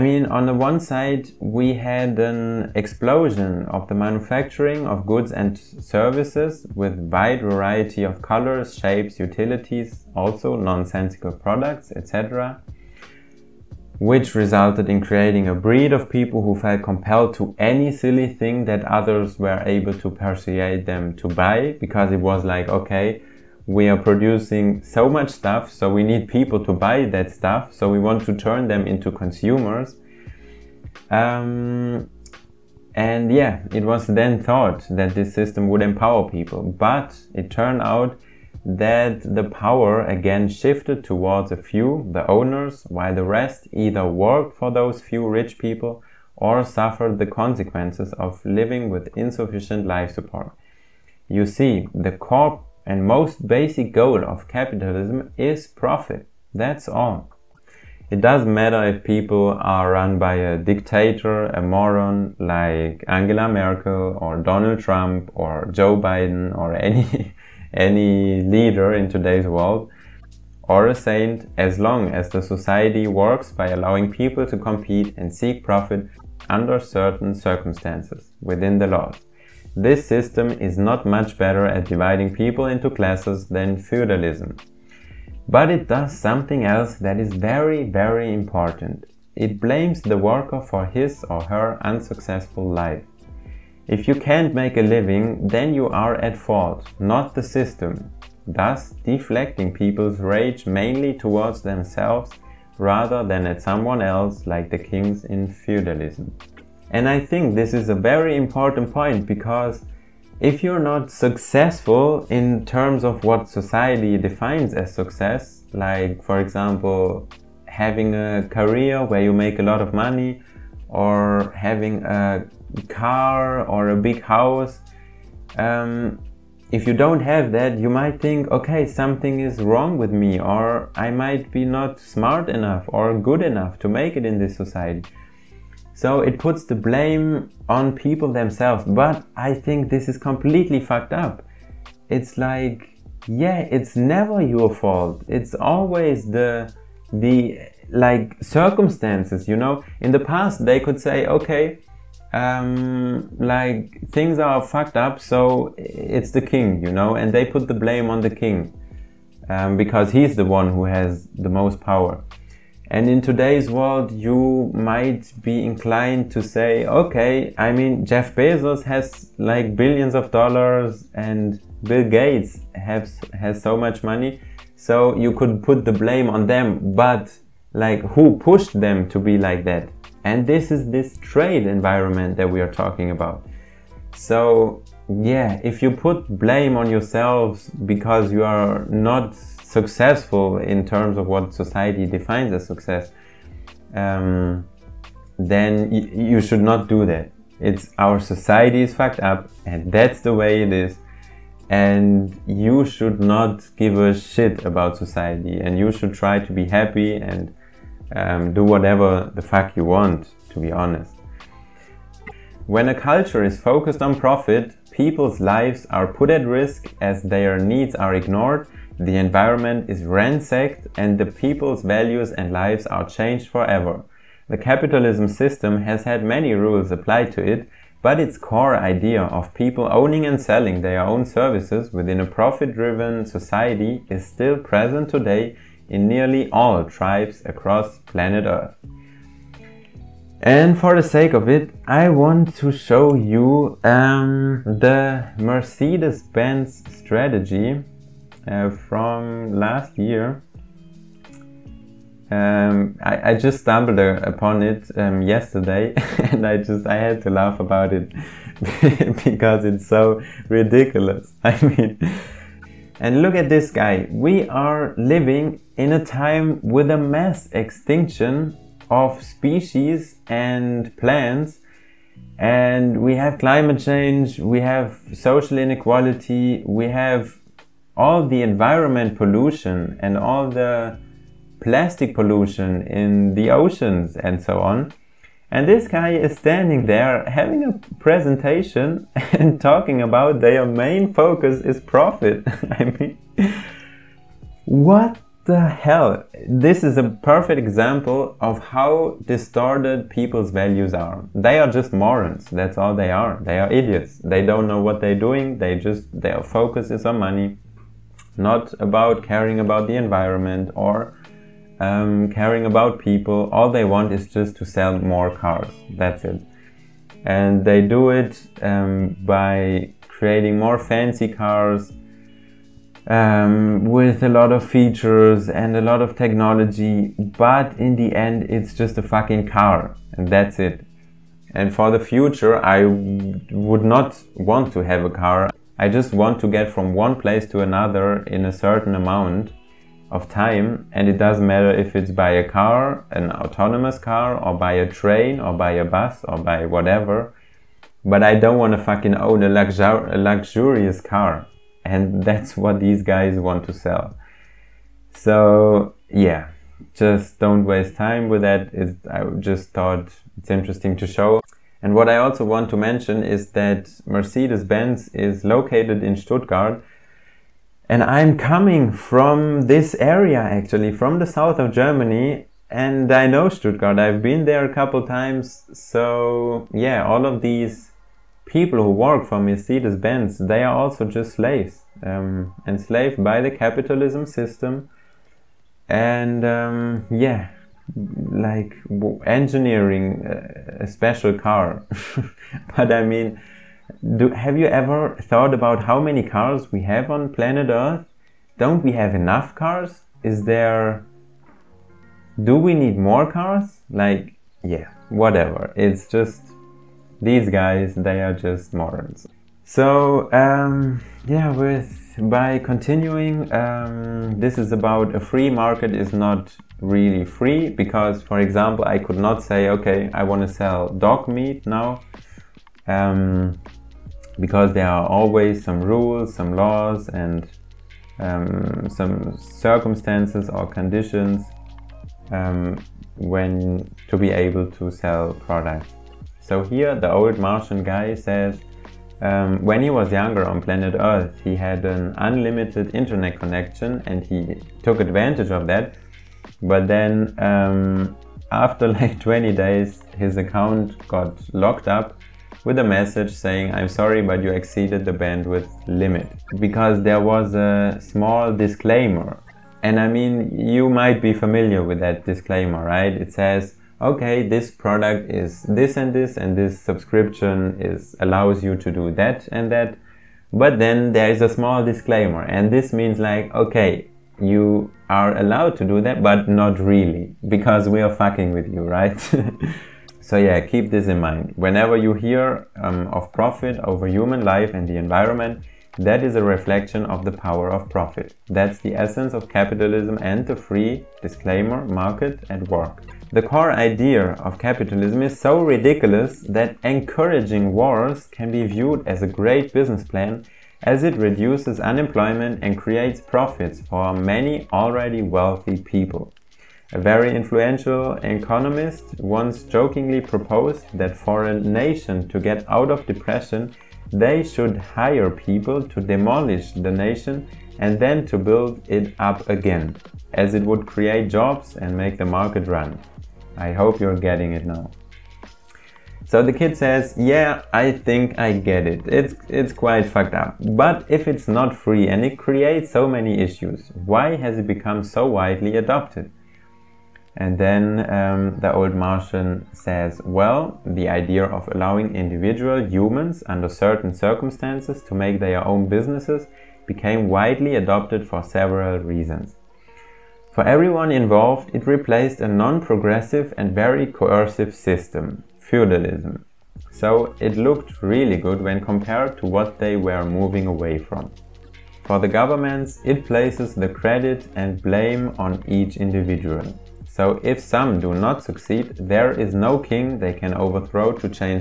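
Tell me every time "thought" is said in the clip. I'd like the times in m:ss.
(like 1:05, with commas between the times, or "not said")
0:34, 5:59, 6:35.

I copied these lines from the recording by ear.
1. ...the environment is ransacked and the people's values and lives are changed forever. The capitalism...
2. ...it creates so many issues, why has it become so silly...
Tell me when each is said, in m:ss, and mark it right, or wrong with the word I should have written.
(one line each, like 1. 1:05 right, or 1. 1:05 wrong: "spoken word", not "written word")
1. 3:38 right
2. 8:52 wrong: "widely", not "silly".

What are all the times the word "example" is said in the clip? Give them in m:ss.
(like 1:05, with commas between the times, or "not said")
1:56, 4:57, 6:58.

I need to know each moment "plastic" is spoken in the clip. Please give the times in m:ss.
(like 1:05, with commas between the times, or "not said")
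4:41.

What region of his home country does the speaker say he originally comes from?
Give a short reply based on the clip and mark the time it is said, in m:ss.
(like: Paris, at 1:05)
the south of Germany, at 6:11.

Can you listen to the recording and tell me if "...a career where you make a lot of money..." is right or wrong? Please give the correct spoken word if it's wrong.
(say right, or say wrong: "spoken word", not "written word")
right.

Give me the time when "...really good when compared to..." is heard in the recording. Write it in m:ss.
9:18.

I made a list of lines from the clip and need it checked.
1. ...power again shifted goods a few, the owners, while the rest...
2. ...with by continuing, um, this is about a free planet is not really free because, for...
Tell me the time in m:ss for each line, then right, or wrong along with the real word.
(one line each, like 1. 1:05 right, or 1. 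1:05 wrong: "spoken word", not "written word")
1. 0:39 wrong: "towards", not "goods"
2. 6:51 wrong: "market", not "planet".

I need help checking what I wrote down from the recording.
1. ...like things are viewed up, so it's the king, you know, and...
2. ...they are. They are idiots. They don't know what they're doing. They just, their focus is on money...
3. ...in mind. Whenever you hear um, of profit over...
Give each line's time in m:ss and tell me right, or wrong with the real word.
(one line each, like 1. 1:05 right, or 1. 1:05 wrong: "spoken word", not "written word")
1. 2:33 wrong: "fucked", not "viewed"
2. 5:02 right
3. 8:01 right.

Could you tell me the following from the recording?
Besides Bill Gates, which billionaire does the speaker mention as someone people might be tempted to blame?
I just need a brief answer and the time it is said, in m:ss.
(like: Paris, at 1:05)
Jeff Bezos, at 2:48.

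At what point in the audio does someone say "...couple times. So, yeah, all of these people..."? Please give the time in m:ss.
6:14.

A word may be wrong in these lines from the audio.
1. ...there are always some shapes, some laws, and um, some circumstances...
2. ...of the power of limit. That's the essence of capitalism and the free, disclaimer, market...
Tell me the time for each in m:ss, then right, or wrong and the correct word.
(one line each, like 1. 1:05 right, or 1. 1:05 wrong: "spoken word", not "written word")
1. 7:04 wrong: "rules", not "shapes"
2. 8:07 wrong: "profit", not "limit".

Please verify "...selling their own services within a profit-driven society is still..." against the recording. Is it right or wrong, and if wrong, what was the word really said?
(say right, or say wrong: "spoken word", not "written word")
right.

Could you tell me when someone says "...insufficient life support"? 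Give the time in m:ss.
0:49.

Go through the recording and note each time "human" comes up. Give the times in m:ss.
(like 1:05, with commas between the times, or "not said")
8:04, 9:02.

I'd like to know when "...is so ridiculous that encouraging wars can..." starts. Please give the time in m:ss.
8:15.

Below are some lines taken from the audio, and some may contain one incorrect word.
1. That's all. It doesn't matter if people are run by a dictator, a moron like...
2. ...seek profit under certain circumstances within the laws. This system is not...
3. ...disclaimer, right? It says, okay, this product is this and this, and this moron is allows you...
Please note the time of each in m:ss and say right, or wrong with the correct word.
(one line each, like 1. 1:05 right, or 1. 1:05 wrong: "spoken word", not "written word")
1. 0:56 right
2. 1:15 right
3. 7:42 wrong: "subscription", not "moron".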